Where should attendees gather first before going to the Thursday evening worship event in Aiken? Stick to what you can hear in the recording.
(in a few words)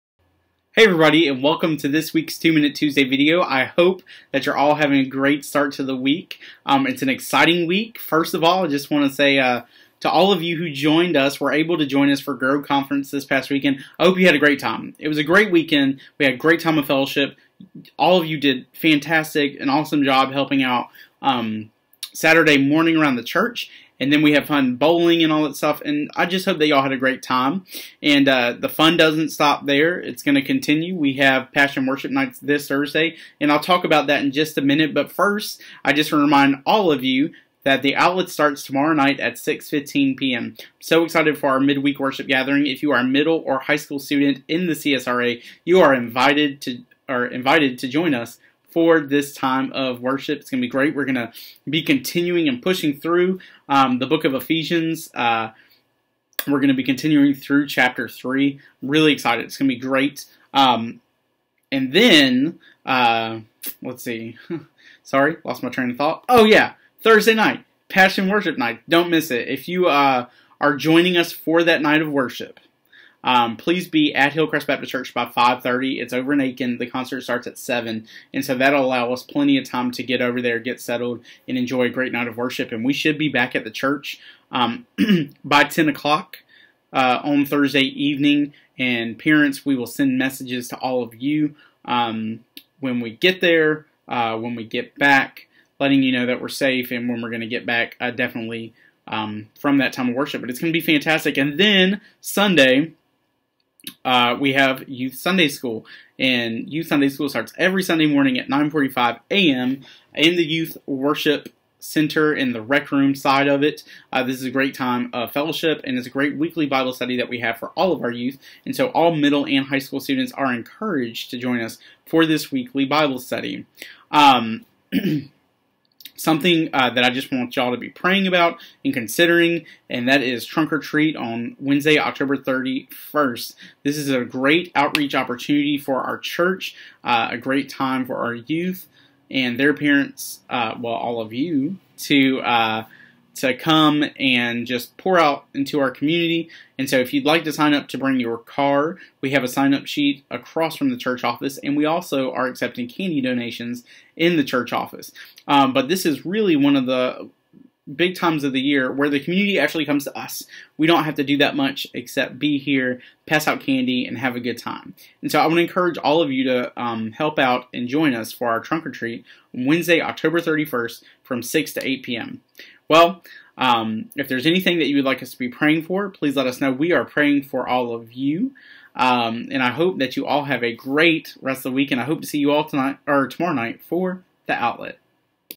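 Hillcrest Baptist Church.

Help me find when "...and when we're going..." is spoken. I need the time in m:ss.
1:36.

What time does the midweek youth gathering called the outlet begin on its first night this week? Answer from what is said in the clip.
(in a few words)
6:15 p.m.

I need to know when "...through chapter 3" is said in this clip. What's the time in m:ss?
0:57.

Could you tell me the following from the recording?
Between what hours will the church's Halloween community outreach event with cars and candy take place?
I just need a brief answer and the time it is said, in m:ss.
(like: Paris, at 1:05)
6 to 8 p.m., at 2:51.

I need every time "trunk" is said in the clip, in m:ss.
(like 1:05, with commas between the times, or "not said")
2:10, 2:48.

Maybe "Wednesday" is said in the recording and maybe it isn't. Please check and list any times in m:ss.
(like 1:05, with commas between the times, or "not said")
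2:11, 2:49.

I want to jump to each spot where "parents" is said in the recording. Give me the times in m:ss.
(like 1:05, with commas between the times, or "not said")
1:29, 2:19.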